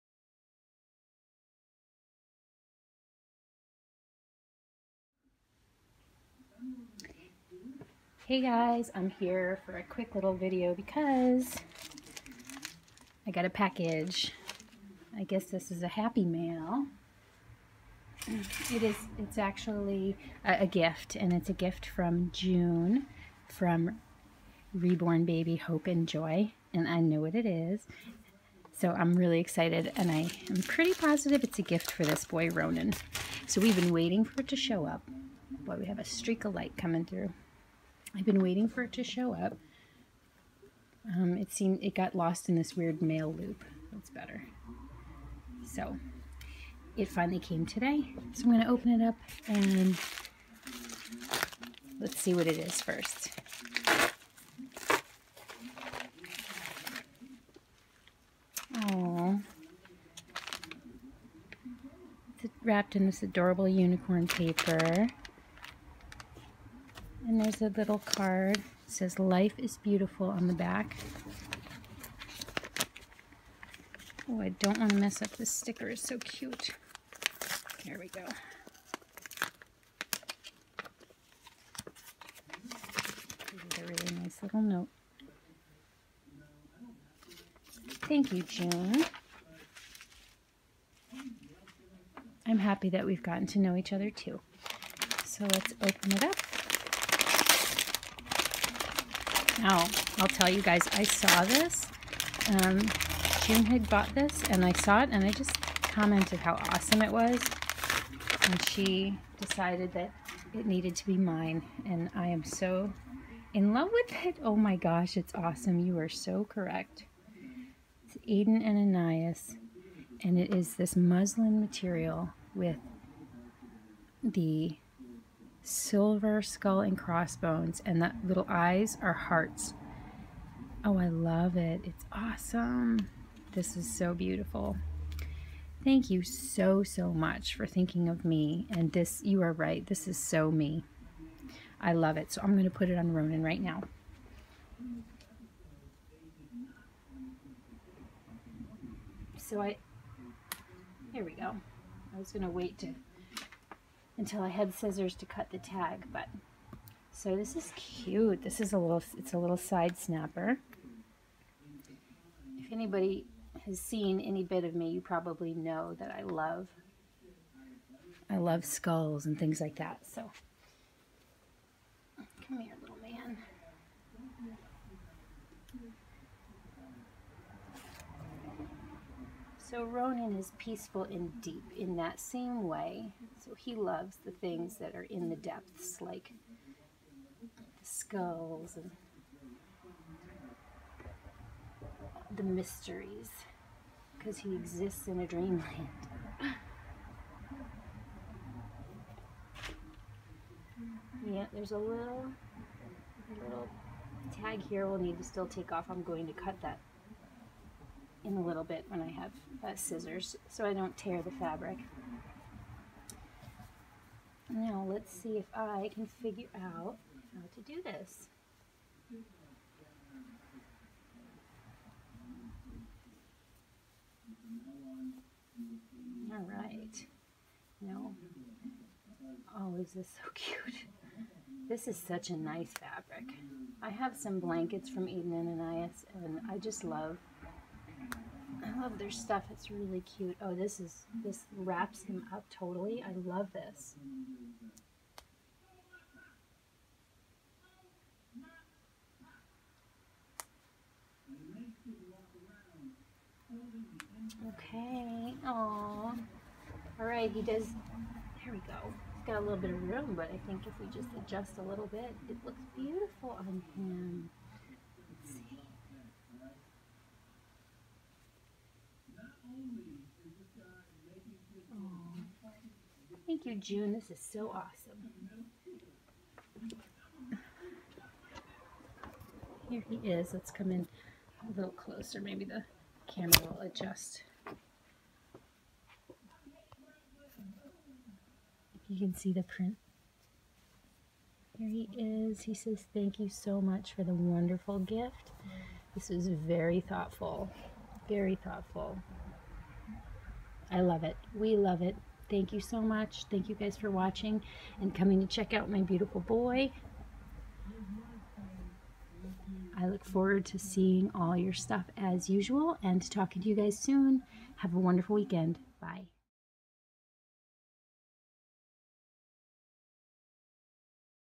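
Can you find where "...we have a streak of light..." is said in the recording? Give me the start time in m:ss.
0:35.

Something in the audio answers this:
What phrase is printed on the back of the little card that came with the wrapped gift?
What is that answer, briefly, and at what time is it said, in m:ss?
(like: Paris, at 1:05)
Life is Beautiful, at 1:09.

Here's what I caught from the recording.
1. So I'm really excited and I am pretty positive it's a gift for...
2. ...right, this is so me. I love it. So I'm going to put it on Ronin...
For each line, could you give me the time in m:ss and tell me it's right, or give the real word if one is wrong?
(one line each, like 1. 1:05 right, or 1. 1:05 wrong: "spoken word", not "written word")
1. 0:28 right
2. 2:19 right.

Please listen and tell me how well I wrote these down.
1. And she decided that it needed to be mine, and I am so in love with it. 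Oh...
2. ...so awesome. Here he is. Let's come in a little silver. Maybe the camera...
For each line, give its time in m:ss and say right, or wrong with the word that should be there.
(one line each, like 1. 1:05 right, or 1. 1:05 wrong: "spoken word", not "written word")
1. 1:48 right
2. 4:34 wrong: "closer", not "silver".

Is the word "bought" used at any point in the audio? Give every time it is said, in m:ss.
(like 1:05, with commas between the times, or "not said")
1:43.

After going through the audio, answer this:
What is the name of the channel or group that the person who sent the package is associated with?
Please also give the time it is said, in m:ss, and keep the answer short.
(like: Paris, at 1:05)
Reborn Baby Hope and Joy, at 0:24.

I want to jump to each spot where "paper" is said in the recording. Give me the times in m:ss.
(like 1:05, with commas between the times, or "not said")
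1:04.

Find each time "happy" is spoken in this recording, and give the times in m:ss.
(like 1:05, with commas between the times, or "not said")
0:15, 1:32.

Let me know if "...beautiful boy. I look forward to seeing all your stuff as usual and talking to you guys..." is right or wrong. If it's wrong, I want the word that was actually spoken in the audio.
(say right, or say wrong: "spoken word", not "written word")
right.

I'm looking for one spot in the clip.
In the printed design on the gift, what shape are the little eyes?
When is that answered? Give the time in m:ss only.
2:09.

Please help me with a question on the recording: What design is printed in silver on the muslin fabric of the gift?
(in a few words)
skull and crossbones.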